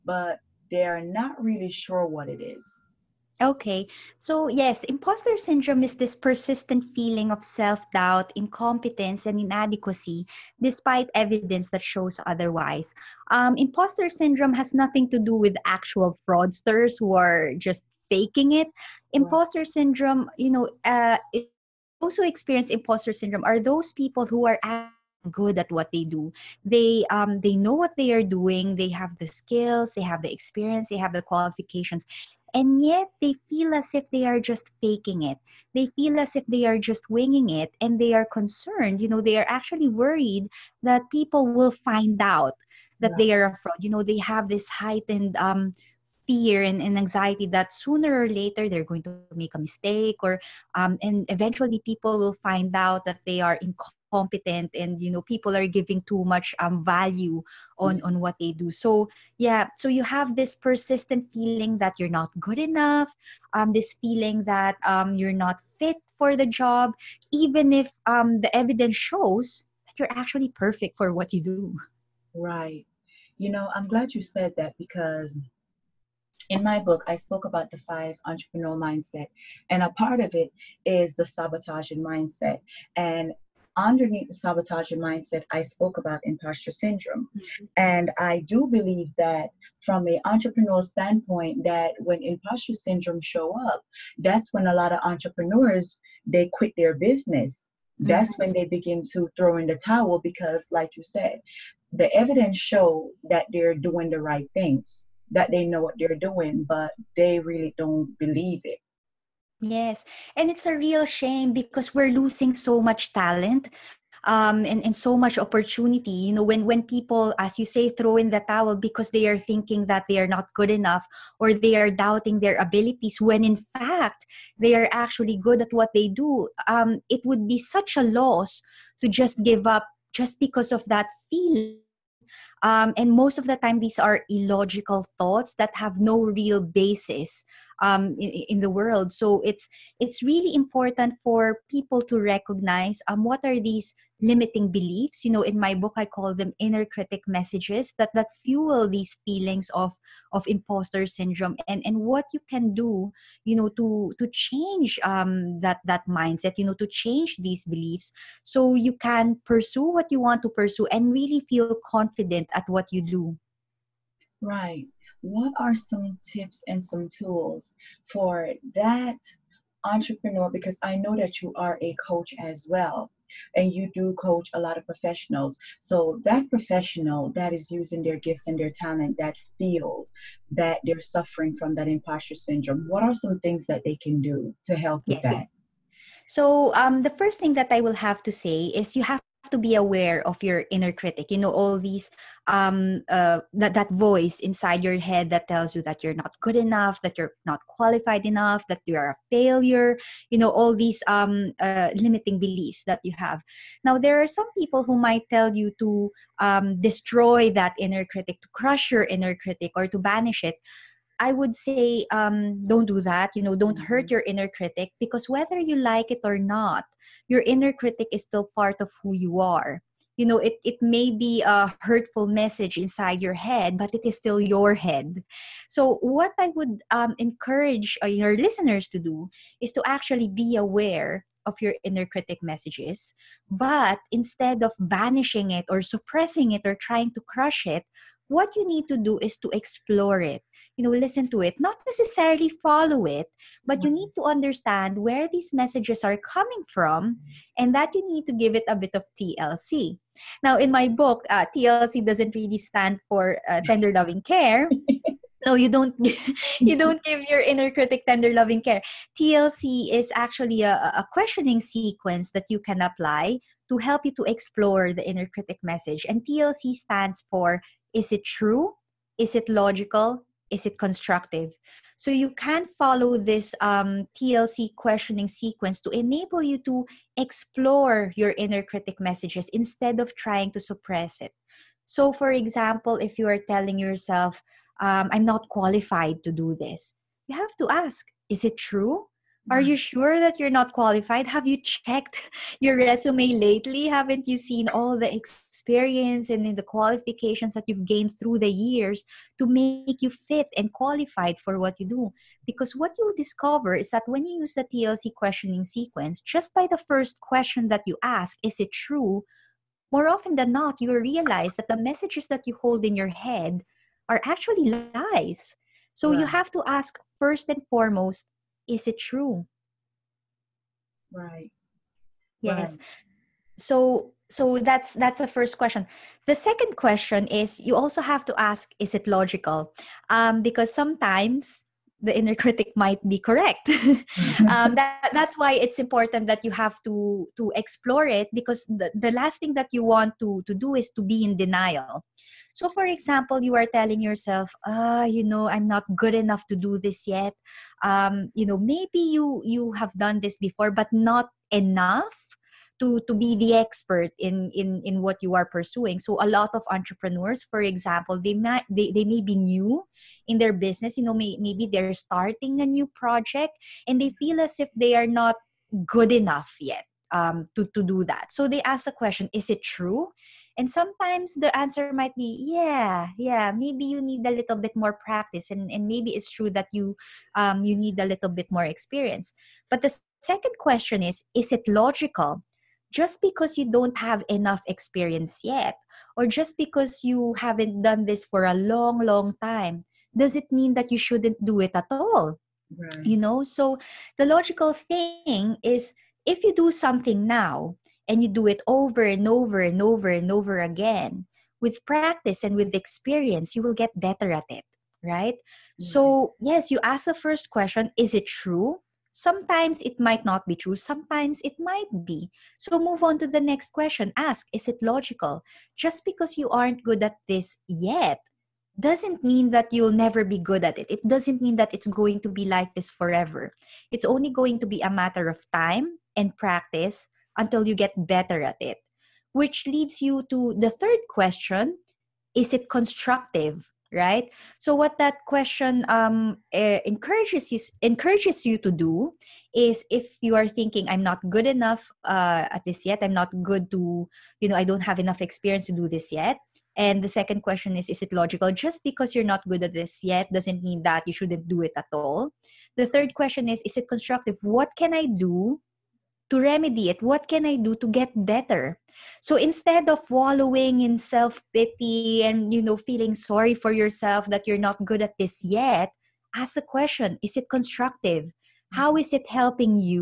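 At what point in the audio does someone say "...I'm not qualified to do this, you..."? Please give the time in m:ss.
4:45.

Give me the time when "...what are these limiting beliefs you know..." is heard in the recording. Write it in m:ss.
2:23.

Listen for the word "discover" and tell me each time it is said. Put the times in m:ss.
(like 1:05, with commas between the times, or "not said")
5:03.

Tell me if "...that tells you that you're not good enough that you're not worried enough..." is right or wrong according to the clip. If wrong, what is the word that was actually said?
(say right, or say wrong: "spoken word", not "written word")
wrong: "qualified", not "worried".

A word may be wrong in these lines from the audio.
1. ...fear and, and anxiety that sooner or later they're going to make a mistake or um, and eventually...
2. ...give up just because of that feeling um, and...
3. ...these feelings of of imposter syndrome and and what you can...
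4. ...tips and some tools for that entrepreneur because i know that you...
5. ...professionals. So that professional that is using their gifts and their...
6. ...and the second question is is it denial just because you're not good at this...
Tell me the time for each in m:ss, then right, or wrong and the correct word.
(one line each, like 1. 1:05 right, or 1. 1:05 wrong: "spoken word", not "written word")
1. 0:46 right
2. 2:09 right
3. 2:28 right
4. 2:46 right
5. 2:54 right
6. 7:26 wrong: "logical", not "denial".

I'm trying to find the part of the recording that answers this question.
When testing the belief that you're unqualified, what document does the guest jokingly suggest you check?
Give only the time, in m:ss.
4:52.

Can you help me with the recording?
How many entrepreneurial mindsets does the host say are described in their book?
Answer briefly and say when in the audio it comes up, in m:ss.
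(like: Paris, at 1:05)
5, at 1:17.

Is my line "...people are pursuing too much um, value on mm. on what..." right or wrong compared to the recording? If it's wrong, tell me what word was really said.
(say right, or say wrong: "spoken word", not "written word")
wrong: "giving", not "pursuing".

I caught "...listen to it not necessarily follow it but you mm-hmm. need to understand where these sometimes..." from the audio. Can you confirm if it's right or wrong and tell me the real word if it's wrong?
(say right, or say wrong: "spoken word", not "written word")
wrong: "messages", not "sometimes".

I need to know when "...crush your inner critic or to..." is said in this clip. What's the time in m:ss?
3:28.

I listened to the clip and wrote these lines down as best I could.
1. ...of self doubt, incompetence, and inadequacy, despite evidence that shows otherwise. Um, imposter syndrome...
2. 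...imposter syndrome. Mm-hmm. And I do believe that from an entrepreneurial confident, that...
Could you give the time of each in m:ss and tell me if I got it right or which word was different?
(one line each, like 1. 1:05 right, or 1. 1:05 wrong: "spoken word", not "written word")
1. 0:07 right
2. 1:26 wrong: "standpoint", not "confident".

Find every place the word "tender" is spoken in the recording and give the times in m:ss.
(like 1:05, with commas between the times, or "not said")
4:13, 4:18.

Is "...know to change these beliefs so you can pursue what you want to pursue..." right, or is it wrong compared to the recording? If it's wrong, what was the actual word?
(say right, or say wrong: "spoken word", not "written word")
right.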